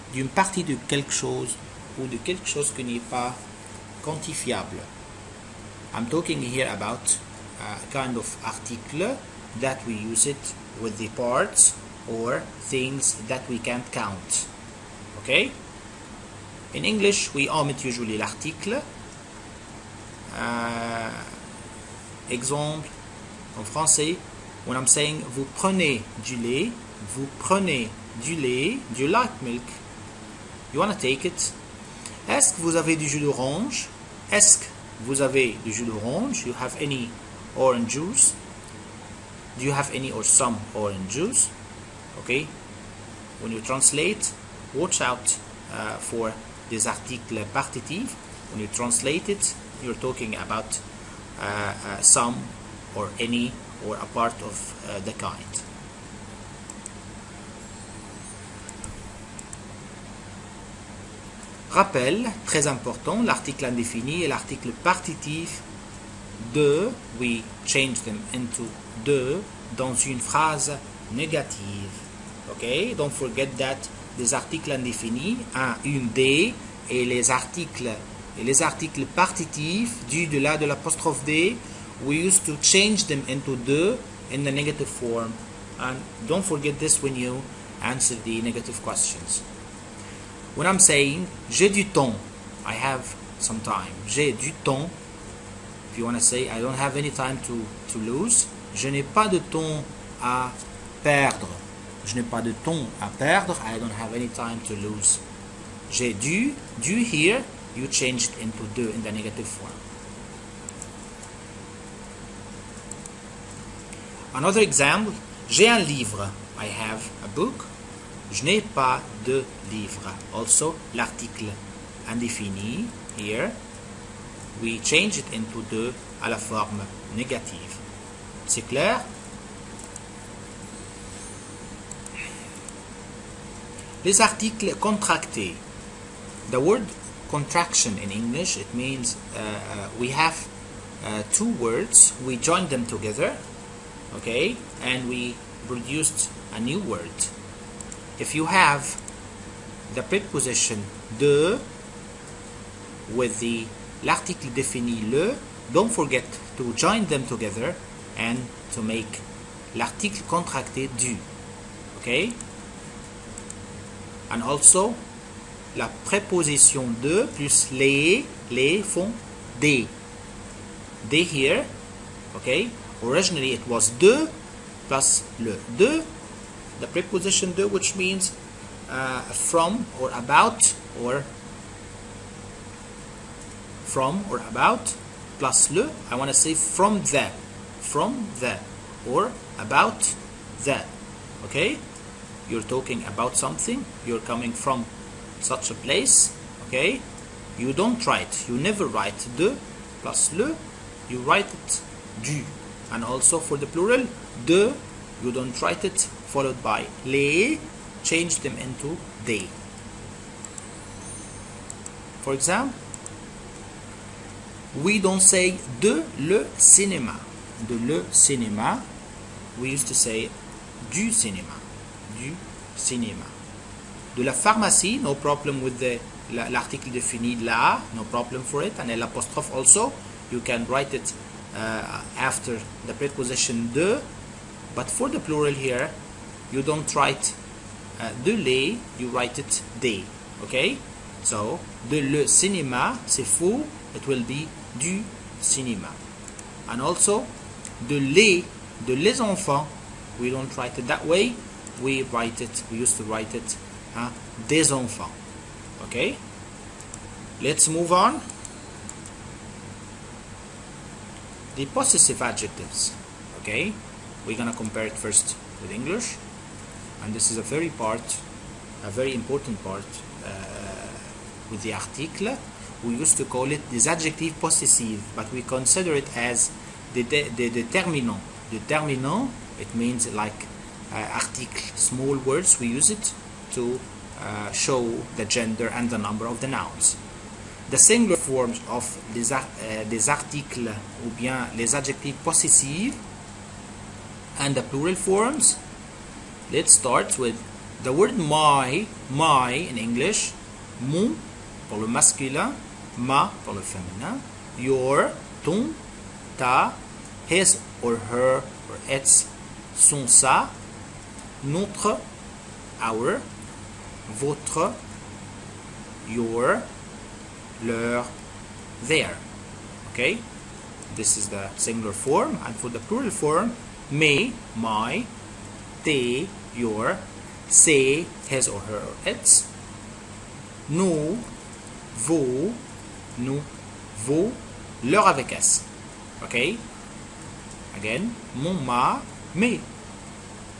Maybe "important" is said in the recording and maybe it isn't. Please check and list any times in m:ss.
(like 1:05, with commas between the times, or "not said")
1:02, 4:29.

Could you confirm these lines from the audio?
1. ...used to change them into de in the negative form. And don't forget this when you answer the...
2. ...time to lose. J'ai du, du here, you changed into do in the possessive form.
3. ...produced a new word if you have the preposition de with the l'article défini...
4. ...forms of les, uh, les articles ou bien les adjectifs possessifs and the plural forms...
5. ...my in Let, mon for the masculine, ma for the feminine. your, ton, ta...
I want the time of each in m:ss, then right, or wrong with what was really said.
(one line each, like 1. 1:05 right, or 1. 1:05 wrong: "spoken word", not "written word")
1. 1:22 right
2. 1:44 wrong: "negative", not "possessive"
3. 2:25 right
4. 4:48 right
5. 4:59 wrong: "English", not "Let".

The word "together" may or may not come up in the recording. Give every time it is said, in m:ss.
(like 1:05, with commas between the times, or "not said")
2:22, 2:37.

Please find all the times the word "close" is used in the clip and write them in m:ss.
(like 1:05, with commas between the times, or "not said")
not said.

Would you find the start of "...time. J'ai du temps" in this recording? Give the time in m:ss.
1:33.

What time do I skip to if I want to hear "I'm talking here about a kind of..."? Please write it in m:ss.
0:05.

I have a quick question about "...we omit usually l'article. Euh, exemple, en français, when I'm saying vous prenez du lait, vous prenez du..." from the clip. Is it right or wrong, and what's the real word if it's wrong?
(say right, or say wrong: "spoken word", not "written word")
right.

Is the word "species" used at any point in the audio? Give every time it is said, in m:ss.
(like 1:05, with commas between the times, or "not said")
not said.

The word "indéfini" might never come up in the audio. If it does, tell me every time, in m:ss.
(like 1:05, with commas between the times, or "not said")
1:03, 1:14, 2:02.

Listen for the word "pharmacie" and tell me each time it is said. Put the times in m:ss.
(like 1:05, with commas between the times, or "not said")
3:44.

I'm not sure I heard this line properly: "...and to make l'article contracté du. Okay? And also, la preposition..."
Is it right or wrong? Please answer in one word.
wrong.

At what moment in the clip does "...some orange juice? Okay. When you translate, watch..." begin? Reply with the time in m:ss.
0:40.